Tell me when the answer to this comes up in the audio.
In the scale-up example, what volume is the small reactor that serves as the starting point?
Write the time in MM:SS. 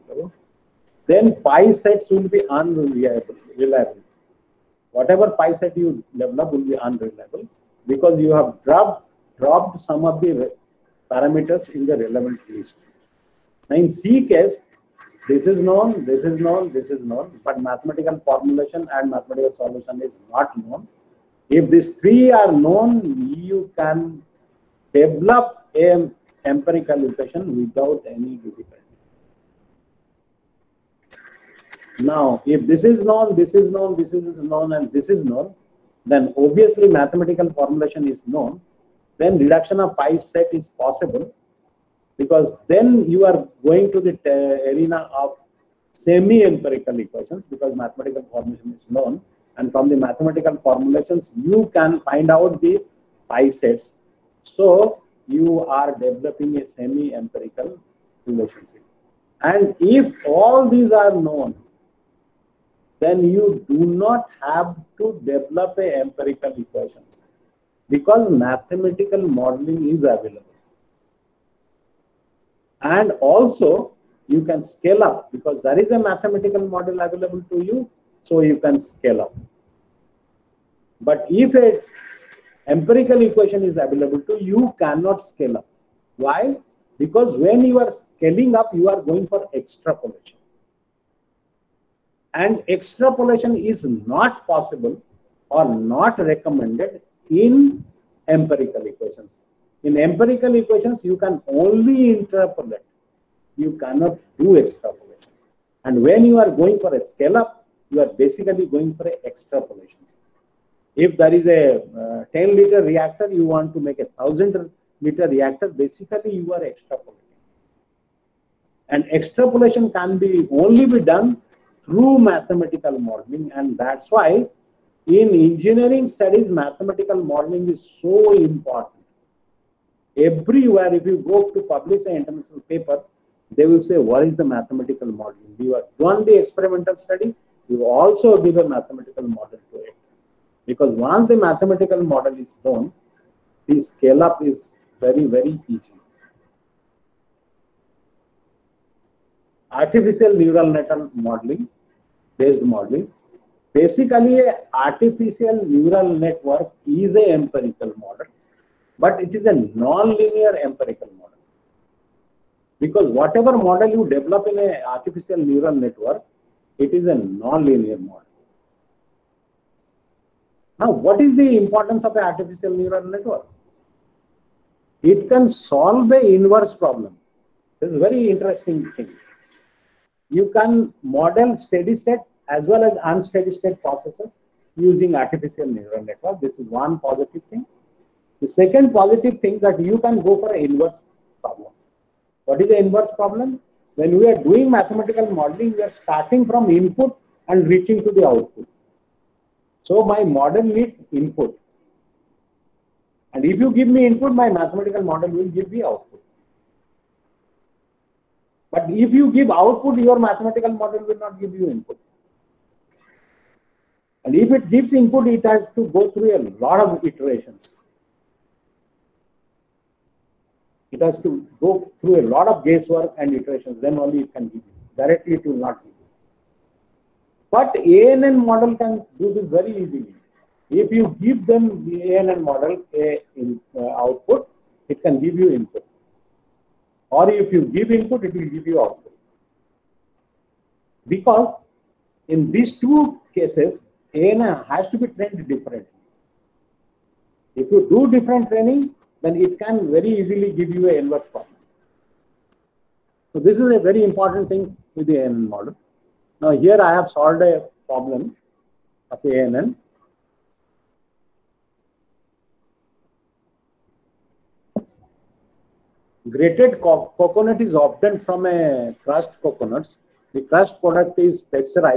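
01:52.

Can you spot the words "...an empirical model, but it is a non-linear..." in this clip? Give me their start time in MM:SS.
02:37.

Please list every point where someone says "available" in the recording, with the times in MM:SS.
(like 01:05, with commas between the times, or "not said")
00:00, 01:10, 01:16, 01:23.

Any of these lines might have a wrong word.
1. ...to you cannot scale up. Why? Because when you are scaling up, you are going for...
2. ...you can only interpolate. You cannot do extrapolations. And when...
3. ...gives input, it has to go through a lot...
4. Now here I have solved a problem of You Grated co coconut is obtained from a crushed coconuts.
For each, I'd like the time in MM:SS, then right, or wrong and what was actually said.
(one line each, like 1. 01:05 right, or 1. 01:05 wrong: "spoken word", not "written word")
1. 01:24 right
2. 01:41 right
3. 03:34 right
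4. 04:16 wrong: "ANN", not "You".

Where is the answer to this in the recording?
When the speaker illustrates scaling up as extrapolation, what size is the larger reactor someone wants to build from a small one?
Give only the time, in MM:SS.
01:54.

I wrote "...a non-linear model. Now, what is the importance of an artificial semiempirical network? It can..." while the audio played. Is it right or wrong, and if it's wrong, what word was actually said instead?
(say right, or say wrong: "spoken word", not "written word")
wrong: "neural", not "semiempirical".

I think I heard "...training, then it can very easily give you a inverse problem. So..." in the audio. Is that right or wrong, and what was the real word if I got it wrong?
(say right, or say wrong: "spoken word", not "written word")
right.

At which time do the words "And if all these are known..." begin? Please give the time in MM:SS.
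00:59.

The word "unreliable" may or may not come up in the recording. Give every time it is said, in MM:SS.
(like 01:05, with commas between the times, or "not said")
00:02, 00:06.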